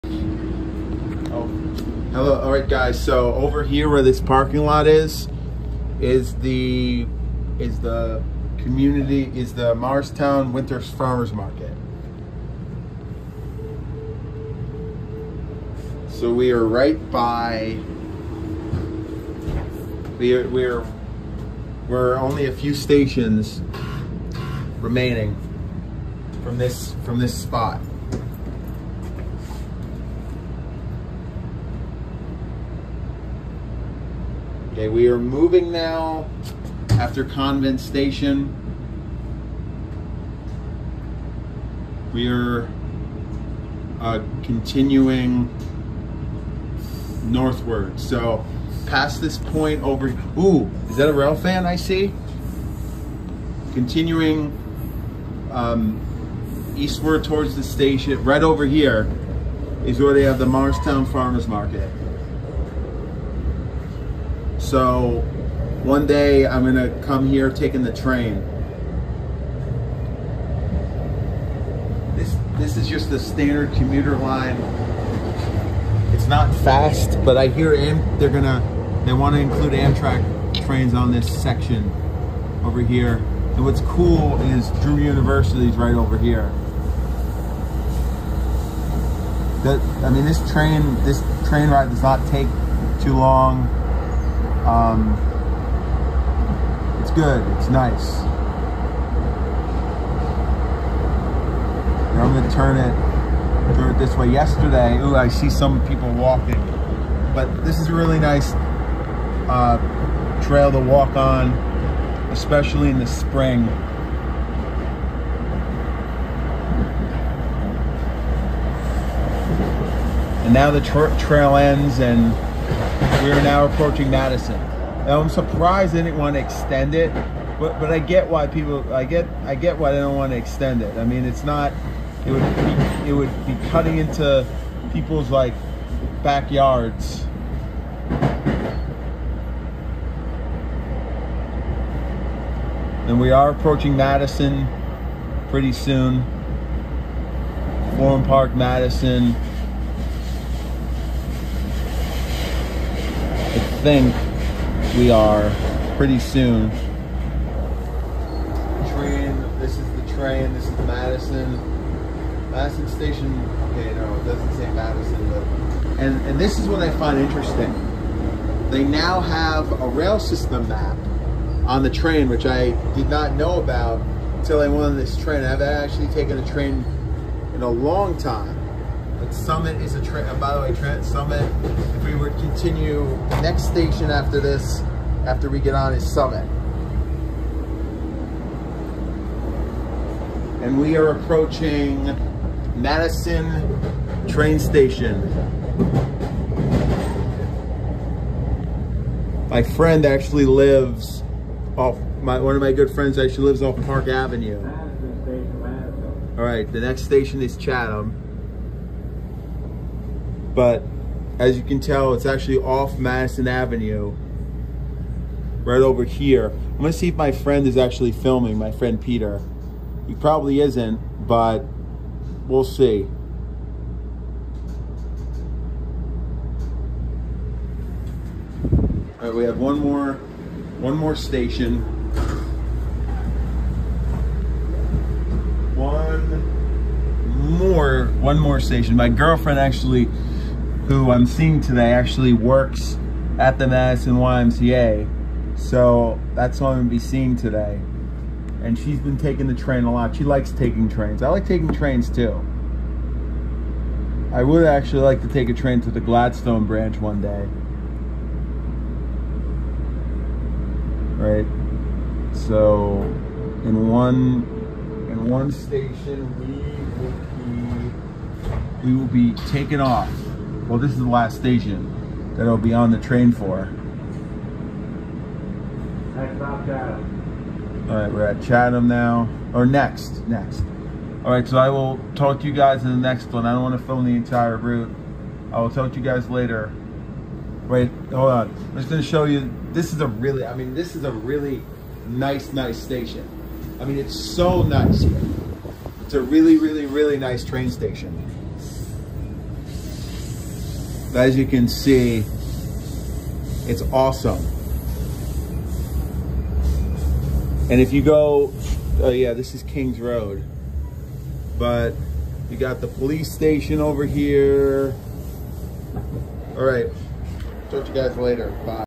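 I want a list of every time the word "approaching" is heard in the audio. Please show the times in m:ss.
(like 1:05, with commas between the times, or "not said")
2:03, 2:23, 3:11.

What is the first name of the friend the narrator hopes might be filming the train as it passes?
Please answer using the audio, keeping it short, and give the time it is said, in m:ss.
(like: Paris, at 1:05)
Peter, at 3:38.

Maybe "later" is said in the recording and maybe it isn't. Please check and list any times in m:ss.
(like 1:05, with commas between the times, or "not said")
4:46, 5:18.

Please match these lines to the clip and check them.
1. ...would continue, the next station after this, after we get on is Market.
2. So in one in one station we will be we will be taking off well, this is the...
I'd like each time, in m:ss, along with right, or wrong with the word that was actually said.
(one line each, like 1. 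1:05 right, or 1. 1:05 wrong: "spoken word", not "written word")
1. 3:02 wrong: "Summit", not "Market"
2. 4:22 right.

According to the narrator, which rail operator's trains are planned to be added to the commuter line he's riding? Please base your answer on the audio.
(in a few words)
Amtrak.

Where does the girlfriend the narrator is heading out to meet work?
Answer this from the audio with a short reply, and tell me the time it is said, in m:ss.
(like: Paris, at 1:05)
Madison YMCA, at 4:03.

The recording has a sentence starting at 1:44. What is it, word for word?
Yesterday, ooh, I see some people walking, but this is a really nice uh, trail to walk on, especially in the spring.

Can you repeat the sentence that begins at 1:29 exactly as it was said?
That, I mean, this train, this train ride does not take too long.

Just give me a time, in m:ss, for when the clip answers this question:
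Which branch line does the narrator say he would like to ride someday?
4:16.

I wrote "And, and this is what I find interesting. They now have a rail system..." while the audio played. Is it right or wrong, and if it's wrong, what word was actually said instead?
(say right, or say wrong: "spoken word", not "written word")
right.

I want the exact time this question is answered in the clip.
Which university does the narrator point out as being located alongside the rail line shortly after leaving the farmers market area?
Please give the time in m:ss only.
1:24.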